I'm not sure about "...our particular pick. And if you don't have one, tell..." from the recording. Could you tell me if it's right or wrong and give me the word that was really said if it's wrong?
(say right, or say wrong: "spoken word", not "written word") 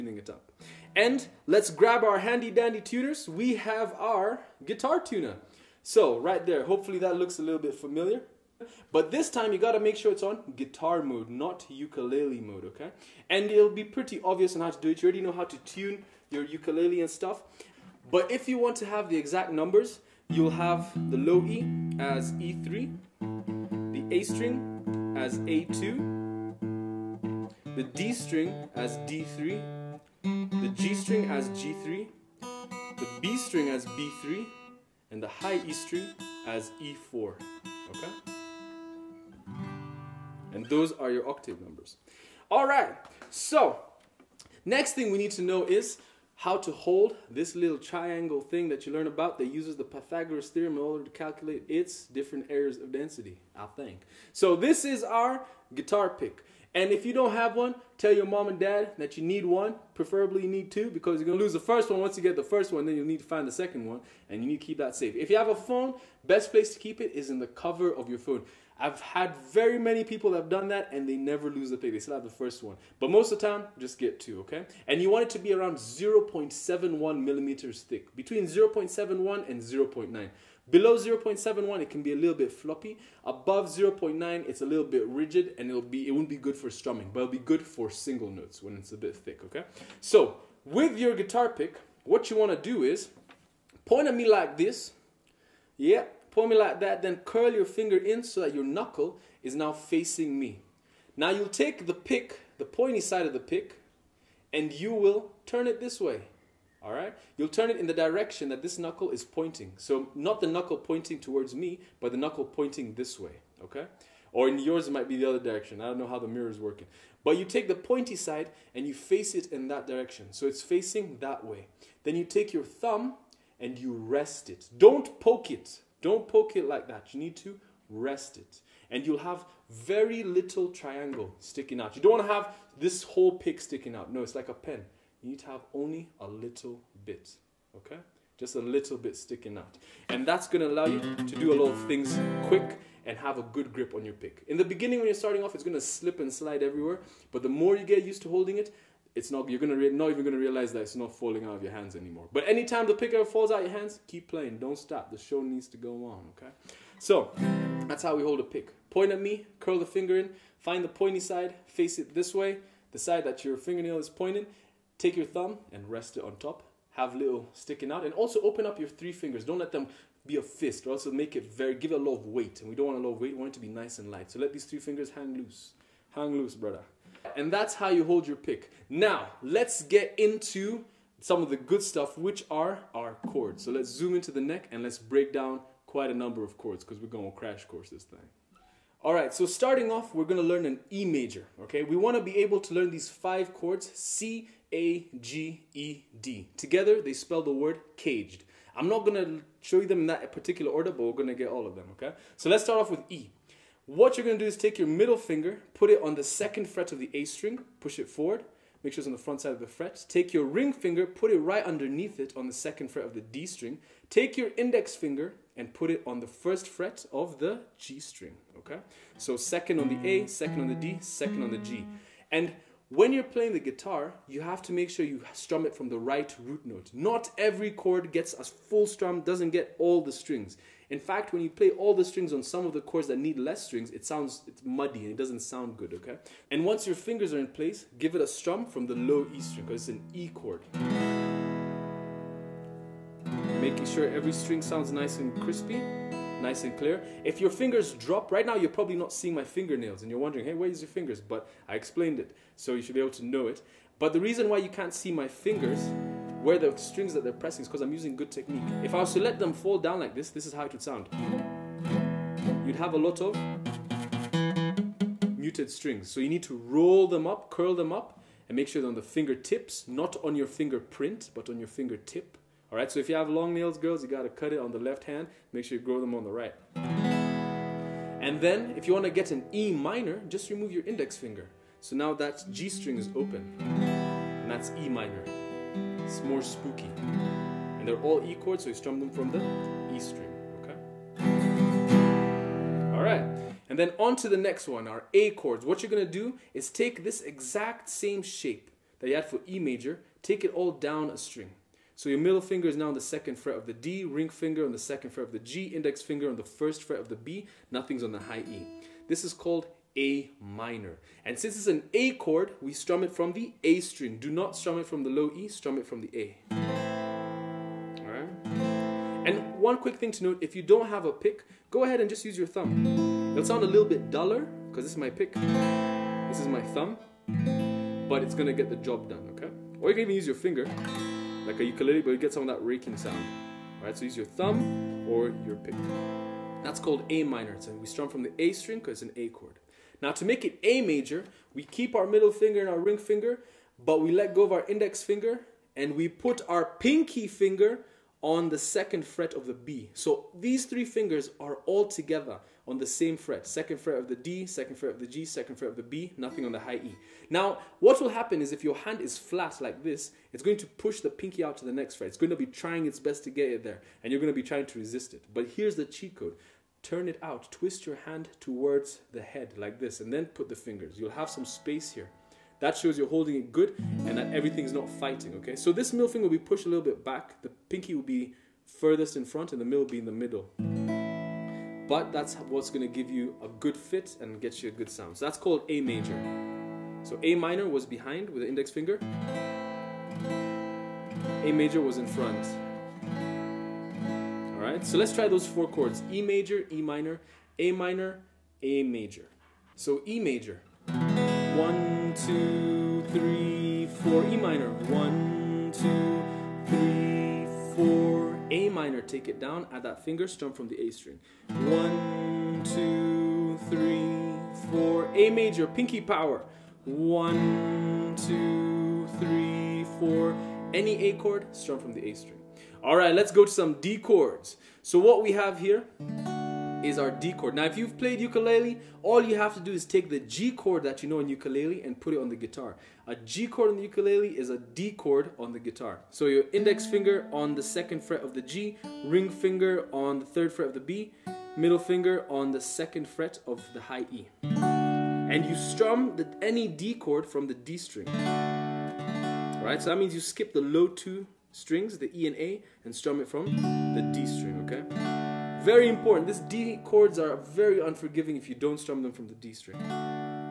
wrong: "guitar", not "particular".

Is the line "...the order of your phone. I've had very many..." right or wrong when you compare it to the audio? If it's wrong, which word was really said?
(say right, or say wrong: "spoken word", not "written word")
wrong: "cover", not "order".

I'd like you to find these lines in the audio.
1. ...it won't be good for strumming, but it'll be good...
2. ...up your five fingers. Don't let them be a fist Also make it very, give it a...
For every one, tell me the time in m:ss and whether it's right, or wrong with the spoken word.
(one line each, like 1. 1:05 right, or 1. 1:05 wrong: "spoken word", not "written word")
1. 1:26 right
2. 2:48 wrong: "three", not "five".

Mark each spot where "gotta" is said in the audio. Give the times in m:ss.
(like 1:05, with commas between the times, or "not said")
0:09.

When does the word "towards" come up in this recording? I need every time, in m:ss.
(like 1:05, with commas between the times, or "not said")
1:51, 6:08.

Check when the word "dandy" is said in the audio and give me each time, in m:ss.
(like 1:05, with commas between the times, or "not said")
0:02.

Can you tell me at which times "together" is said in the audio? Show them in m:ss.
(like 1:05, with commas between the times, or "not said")
3:16, 5:51.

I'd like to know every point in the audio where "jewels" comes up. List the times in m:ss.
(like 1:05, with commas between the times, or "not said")
not said.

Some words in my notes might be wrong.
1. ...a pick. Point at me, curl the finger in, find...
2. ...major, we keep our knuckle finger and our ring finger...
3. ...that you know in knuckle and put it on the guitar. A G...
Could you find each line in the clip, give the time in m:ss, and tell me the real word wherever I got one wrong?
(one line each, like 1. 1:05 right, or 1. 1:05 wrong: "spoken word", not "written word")
1. 2:38 right
2. 5:40 wrong: "middle", not "knuckle"
3. 7:10 wrong: "ukulele", not "knuckle".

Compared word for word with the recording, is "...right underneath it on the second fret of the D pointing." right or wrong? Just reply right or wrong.
wrong.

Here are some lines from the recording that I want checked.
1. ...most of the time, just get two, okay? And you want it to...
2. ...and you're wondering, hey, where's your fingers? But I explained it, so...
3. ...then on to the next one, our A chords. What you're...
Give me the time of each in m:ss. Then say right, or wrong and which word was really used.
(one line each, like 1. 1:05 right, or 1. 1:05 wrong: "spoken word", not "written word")
1. 1:13 right
2. 4:10 right
3. 4:53 right.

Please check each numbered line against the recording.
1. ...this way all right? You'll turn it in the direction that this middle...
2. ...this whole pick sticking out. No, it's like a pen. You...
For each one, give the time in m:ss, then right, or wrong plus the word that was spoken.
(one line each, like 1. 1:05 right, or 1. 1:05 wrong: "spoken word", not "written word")
1. 1:45 wrong: "knuckle", not "middle"
2. 2:12 right.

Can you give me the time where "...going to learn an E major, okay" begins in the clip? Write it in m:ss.
3:10.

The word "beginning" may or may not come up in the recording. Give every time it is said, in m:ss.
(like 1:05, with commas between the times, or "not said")
2:24.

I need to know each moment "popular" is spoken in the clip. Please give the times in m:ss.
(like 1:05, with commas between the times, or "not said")
not said.